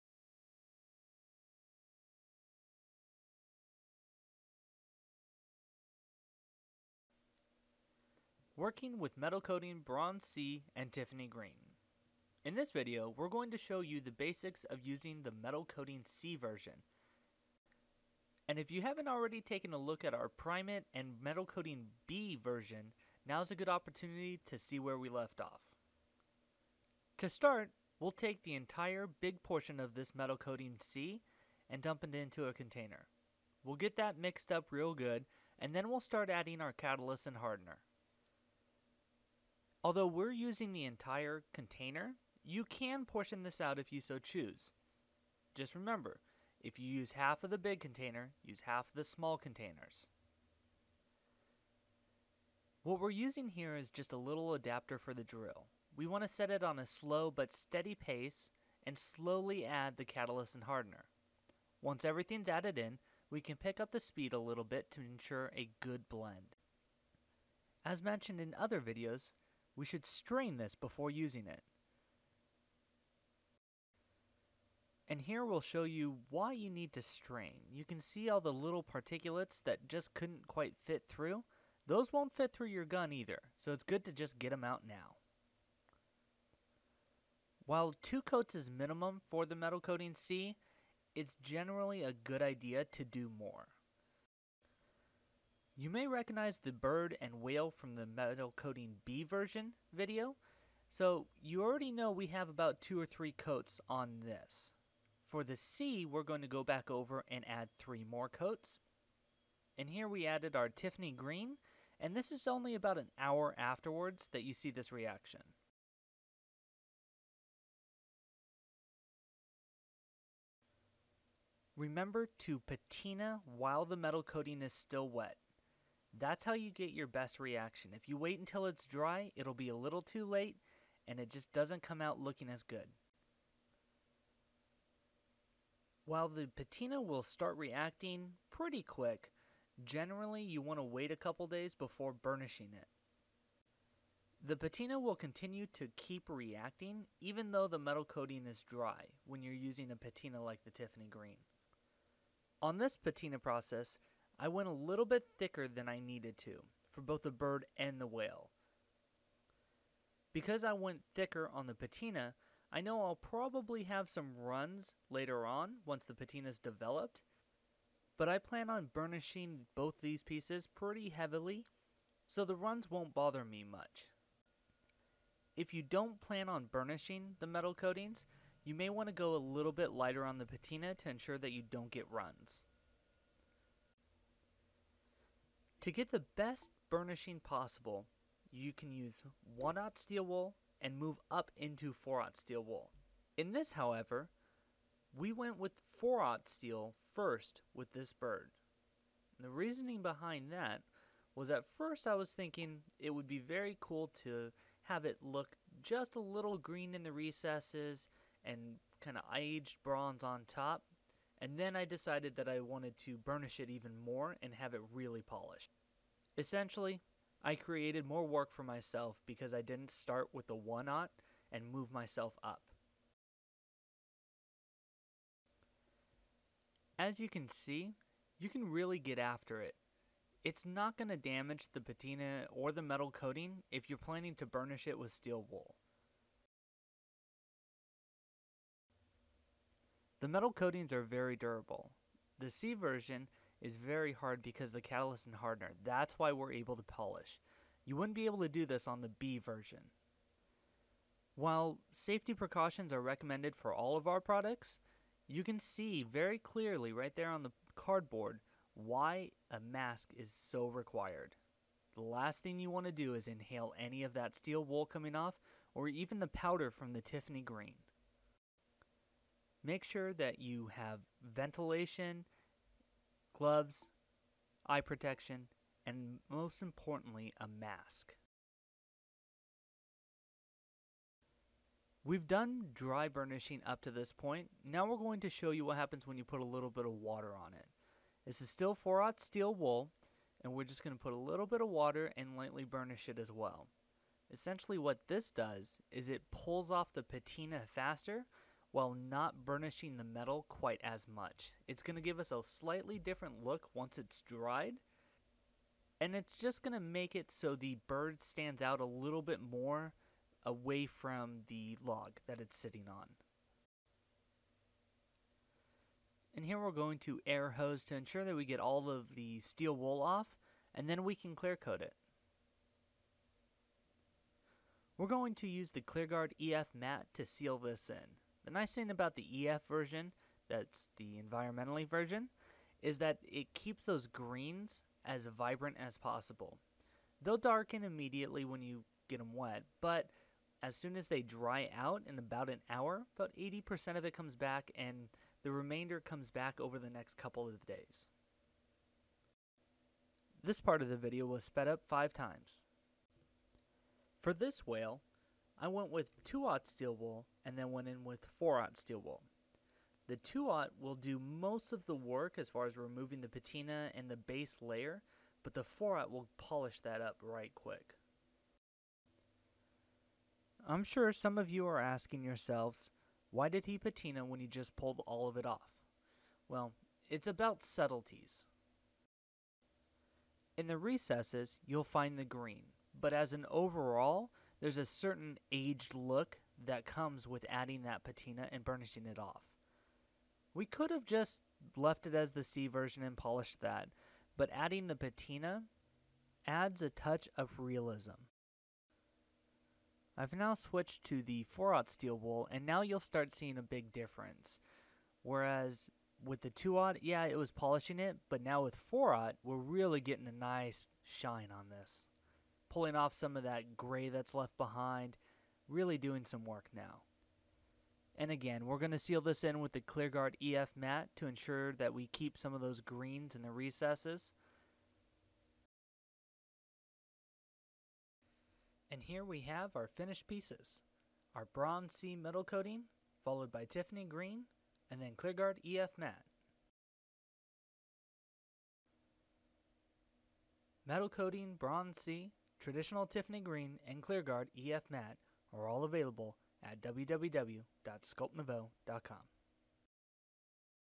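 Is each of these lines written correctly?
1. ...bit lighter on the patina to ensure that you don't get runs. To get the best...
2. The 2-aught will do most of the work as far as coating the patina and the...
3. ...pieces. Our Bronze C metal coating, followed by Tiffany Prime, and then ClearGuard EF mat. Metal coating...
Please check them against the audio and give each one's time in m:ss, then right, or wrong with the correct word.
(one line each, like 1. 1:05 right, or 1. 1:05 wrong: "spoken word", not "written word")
1. 2:59 right
2. 6:00 wrong: "removing", not "coating"
3. 7:10 wrong: "Green", not "Prime".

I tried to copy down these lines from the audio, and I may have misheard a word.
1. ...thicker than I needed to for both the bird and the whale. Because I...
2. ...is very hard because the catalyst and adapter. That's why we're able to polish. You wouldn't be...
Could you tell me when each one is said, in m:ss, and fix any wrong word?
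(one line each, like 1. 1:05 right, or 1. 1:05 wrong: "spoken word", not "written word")
1. 2:35 right
2. 4:03 wrong: "hardener", not "adapter".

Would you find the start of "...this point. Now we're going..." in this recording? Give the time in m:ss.
4:43.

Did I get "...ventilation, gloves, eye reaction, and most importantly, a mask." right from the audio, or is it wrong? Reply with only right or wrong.
wrong.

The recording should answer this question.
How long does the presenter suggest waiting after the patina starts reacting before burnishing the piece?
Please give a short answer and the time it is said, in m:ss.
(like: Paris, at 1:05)
A couple days, at 2:21.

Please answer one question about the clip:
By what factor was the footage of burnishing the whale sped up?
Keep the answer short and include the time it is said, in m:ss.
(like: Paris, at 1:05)
5 times, at 5:51.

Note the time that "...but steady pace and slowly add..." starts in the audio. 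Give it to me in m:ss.
0:57.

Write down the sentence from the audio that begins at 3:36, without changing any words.
Essentially, I created more work for myself because I didn't start with the one aught and move myself up.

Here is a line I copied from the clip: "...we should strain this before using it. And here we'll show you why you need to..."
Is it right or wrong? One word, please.
right.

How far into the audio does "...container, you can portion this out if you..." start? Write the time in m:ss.
0:41.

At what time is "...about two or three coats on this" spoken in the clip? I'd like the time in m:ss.
1:42.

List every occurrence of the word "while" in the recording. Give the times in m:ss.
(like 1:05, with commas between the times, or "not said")
1:27, 2:03, 2:16, 4:11, 4:58.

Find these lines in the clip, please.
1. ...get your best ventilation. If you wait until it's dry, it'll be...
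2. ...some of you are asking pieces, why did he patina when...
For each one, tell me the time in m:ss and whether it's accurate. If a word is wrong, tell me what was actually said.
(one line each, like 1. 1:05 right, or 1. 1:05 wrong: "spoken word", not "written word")
1. 2:06 wrong: "reaction", not "ventilation"
2. 6:11 wrong: "yourselves", not "pieces".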